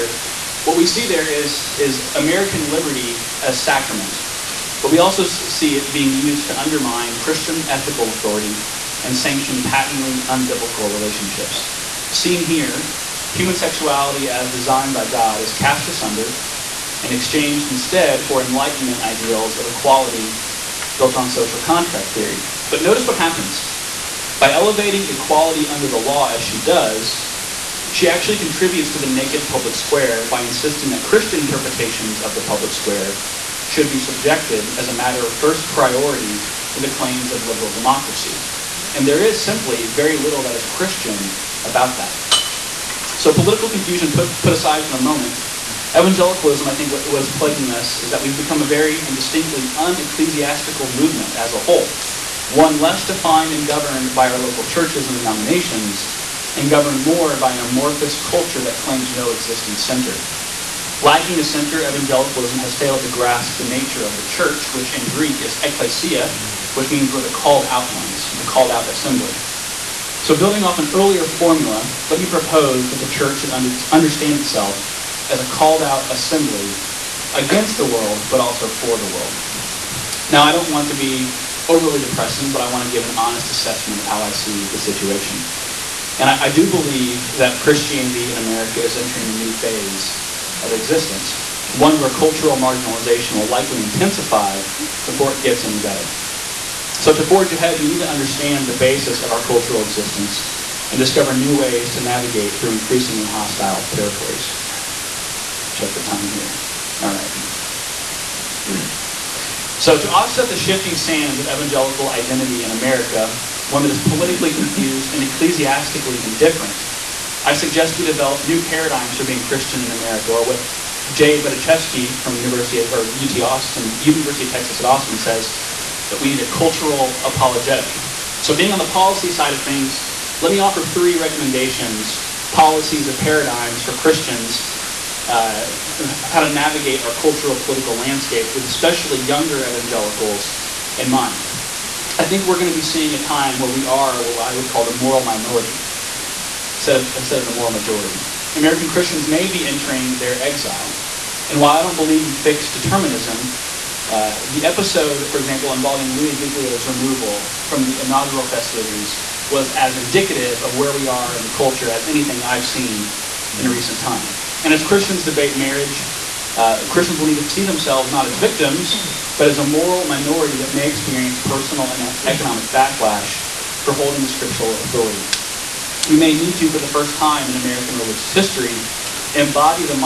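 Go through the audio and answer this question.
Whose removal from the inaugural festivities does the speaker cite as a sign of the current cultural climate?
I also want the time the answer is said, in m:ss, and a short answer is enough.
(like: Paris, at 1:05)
Louis Giglio, at 2:36.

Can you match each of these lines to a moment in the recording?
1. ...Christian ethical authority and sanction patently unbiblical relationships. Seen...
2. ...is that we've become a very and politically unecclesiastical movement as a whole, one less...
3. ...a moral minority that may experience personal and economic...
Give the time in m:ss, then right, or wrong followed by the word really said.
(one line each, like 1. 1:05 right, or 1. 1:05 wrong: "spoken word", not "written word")
1. 0:07 right
2. 0:47 wrong: "distinctly", not "politically"
3. 2:49 right.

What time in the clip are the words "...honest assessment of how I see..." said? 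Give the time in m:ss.
1:23.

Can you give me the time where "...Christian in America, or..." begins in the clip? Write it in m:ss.
1:59.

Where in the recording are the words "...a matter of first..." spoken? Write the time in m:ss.
0:34.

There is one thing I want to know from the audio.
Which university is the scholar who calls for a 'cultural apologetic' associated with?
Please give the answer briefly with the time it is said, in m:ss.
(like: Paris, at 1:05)
University of Texas at Austin, at 2:04.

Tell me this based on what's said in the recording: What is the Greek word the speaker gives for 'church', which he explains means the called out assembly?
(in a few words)
ecclesia.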